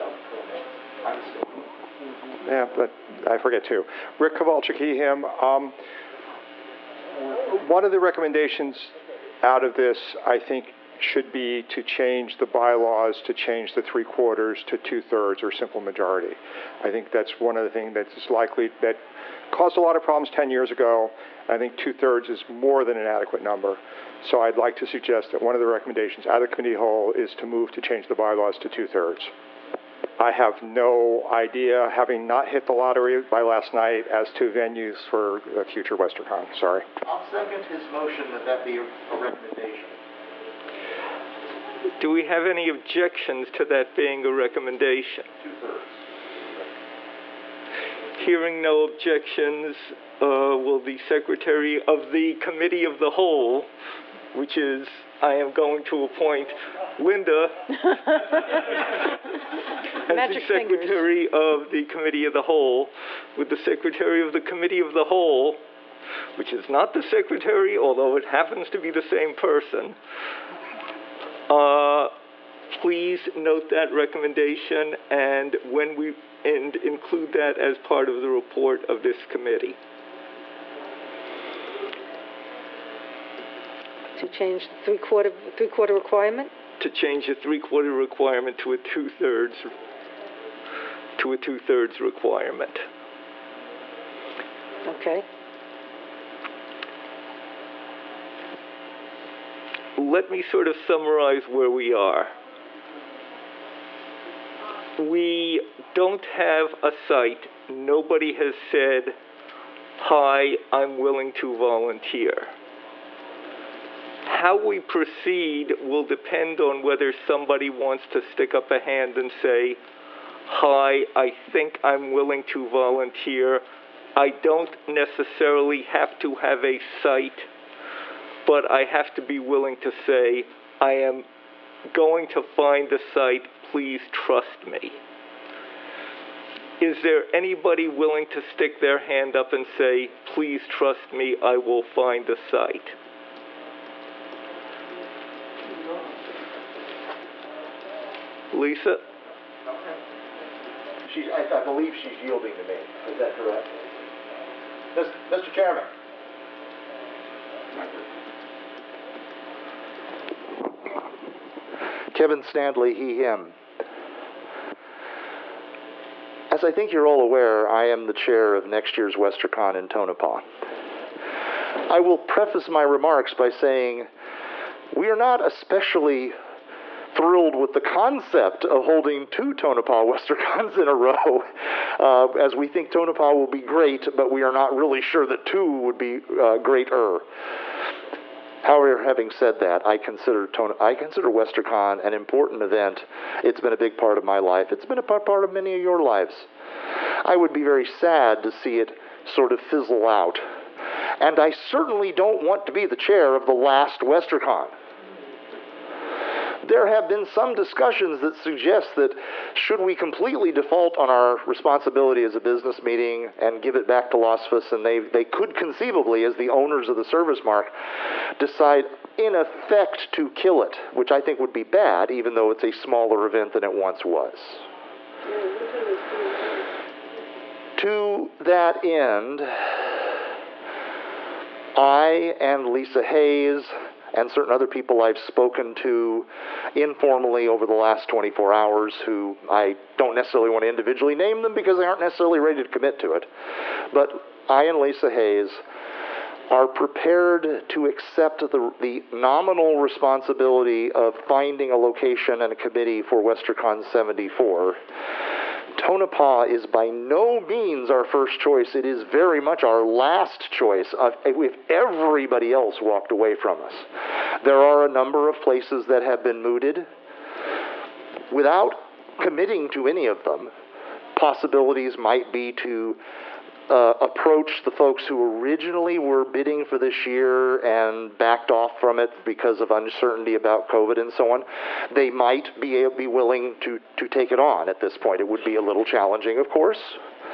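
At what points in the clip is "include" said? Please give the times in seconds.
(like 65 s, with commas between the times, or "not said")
76 s.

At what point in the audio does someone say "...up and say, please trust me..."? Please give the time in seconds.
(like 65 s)
139 s.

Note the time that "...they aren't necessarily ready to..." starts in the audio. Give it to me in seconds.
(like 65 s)
241 s.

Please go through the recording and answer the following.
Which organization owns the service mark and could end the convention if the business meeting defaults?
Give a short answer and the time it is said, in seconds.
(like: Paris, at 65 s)
LASFS, at 214 s.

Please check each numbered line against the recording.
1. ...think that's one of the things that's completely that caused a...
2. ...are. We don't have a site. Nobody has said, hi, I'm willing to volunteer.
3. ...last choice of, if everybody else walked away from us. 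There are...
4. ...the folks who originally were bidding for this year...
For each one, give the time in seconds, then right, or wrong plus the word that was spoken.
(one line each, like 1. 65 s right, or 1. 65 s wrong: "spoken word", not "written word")
1. 16 s wrong: "likely", not "completely"
2. 101 s right
3. 259 s right
4. 274 s right.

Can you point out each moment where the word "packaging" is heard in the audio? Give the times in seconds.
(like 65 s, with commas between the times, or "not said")
not said.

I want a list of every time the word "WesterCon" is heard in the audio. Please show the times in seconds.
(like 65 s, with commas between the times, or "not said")
35 s, 169 s, 180 s, 191 s, 204 s, 253 s.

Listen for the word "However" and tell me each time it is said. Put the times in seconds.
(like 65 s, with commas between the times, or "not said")
188 s.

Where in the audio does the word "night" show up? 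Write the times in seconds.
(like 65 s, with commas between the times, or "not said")
33 s.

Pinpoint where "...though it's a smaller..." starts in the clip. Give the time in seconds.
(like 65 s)
222 s.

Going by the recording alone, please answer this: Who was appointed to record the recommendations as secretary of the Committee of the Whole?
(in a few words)
Linda.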